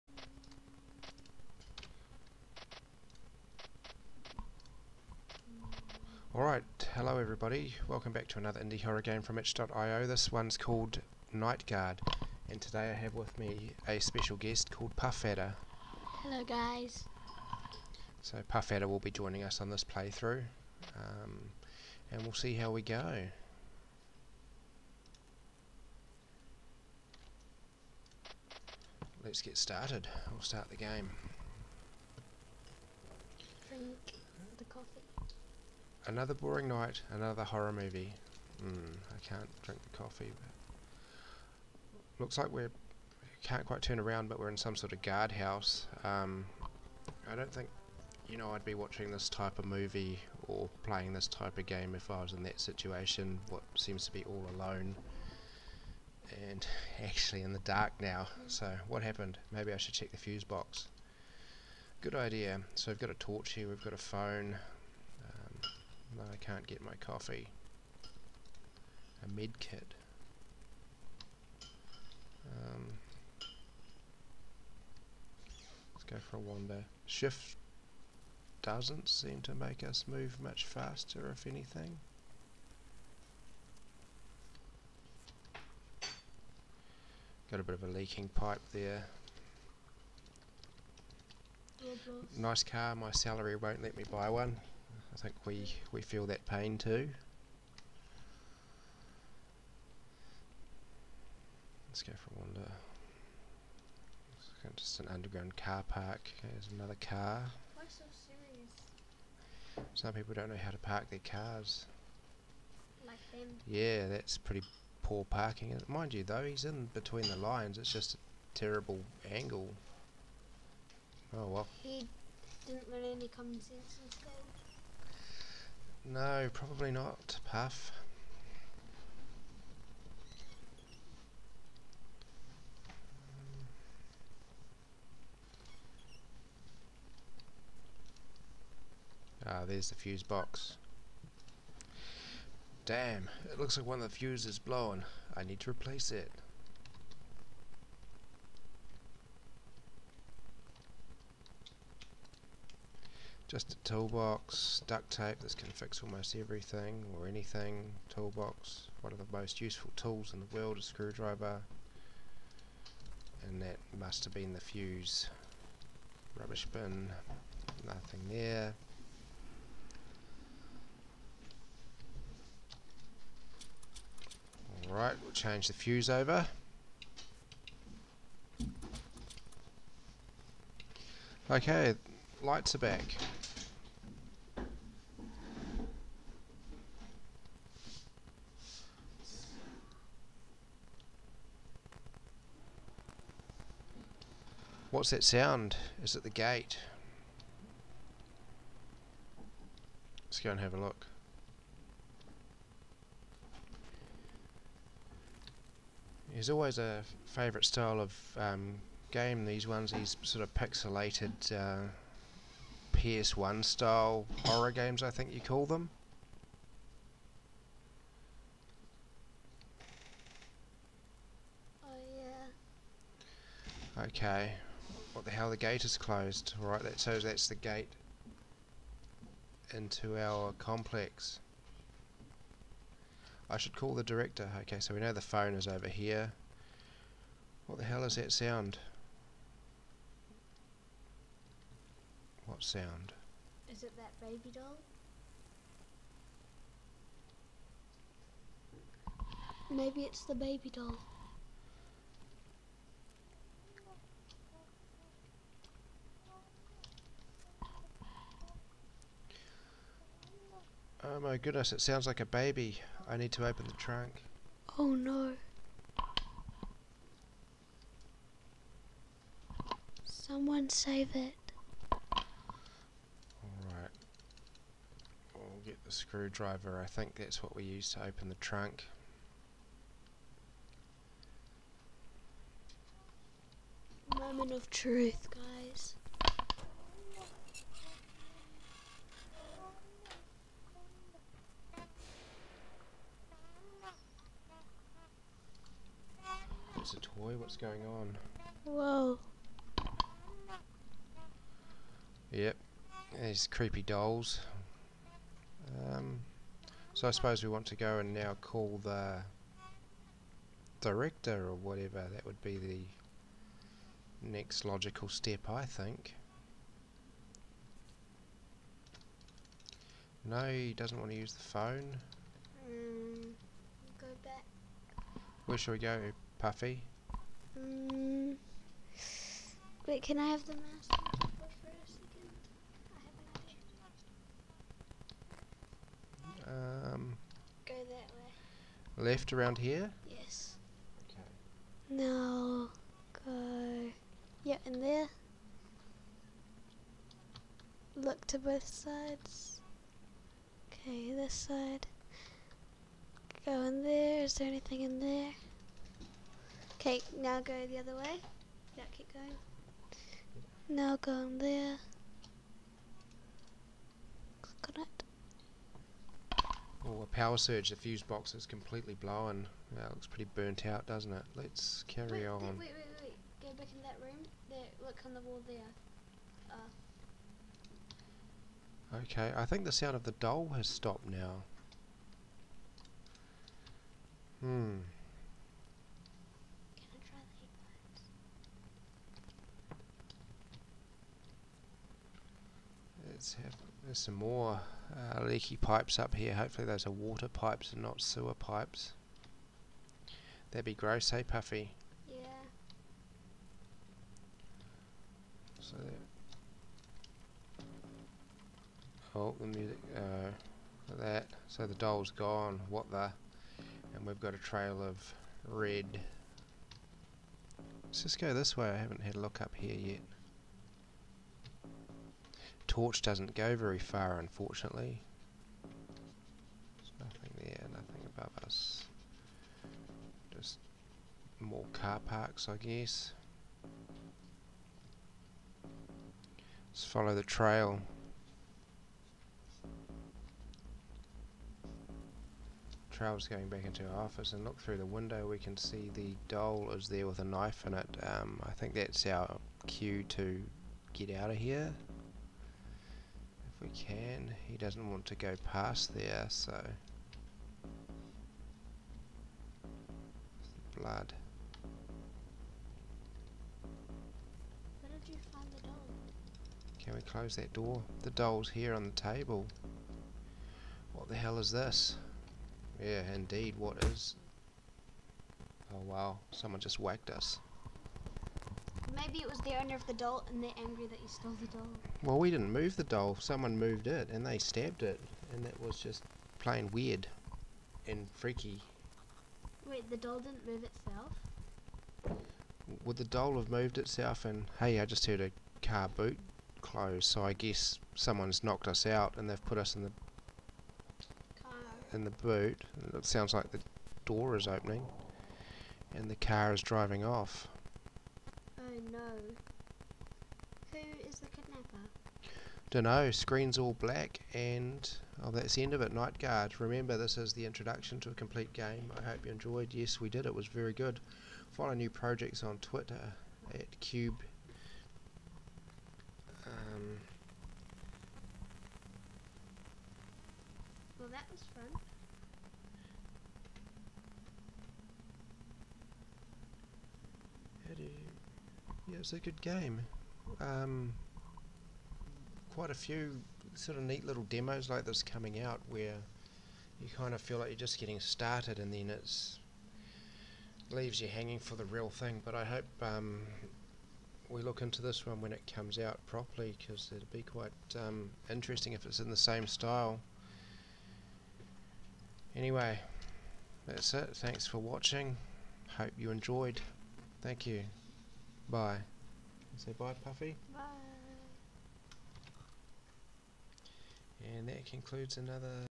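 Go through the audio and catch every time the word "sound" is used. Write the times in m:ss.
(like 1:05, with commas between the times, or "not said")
3:15, 3:58, 4:02, 4:21, 6:19, 8:23.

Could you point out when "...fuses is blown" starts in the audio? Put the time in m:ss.
2:24.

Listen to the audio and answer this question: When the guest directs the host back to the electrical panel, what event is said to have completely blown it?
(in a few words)
A power surge.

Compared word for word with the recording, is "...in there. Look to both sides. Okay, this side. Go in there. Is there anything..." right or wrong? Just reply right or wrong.
right.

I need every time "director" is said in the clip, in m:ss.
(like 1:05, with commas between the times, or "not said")
3:54, 5:10.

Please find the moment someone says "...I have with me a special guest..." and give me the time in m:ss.
0:12.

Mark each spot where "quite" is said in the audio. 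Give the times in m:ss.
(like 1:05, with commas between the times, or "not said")
0:43, 9:02, 9:17.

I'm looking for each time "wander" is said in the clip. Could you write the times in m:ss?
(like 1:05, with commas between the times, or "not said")
1:16, 1:42.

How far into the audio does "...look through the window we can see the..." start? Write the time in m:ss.
7:24.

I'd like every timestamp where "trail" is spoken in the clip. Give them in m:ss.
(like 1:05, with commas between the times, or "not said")
6:54, 7:17, 7:22.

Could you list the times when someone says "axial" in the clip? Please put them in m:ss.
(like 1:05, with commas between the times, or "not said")
not said.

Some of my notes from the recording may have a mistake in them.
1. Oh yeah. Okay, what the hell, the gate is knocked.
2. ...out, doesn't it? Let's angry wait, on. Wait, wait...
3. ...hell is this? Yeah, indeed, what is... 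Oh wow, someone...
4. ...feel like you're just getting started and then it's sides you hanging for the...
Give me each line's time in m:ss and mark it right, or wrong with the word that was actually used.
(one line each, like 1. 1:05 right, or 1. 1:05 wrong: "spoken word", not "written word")
1. 3:41 wrong: "closed", not "knocked"
2. 6:10 wrong: "carry", not "angry"
3. 7:51 right
4. 9:07 wrong: "leaves", not "sides".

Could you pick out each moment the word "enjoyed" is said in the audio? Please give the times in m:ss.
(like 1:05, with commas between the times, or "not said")
8:39, 9:26.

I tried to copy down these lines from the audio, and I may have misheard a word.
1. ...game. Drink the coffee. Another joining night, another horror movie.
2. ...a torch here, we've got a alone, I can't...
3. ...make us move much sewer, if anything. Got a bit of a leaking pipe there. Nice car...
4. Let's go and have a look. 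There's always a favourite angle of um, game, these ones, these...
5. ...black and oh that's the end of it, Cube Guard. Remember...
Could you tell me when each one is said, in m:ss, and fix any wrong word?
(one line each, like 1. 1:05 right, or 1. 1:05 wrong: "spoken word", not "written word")
1. 0:30 wrong: "boring", not "joining"
2. 1:03 wrong: "phone", not "alone"
3. 1:19 wrong: "faster", not "sewer"
4. 3:20 wrong: "style", not "angle"
5. 8:33 wrong: "Night", not "Cube".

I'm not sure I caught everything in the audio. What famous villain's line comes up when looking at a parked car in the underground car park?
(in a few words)
Why so serious?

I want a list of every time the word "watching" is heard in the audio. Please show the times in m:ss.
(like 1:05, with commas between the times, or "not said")
0:48, 9:24.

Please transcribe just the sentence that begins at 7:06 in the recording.
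There's nothing there, nothing above us.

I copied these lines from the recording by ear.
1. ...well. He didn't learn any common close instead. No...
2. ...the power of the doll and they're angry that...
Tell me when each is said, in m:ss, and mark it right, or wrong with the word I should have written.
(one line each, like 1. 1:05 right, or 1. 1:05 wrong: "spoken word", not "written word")
1. 2:01 wrong: "sense", not "close"
2. 7:59 wrong: "owner", not "power".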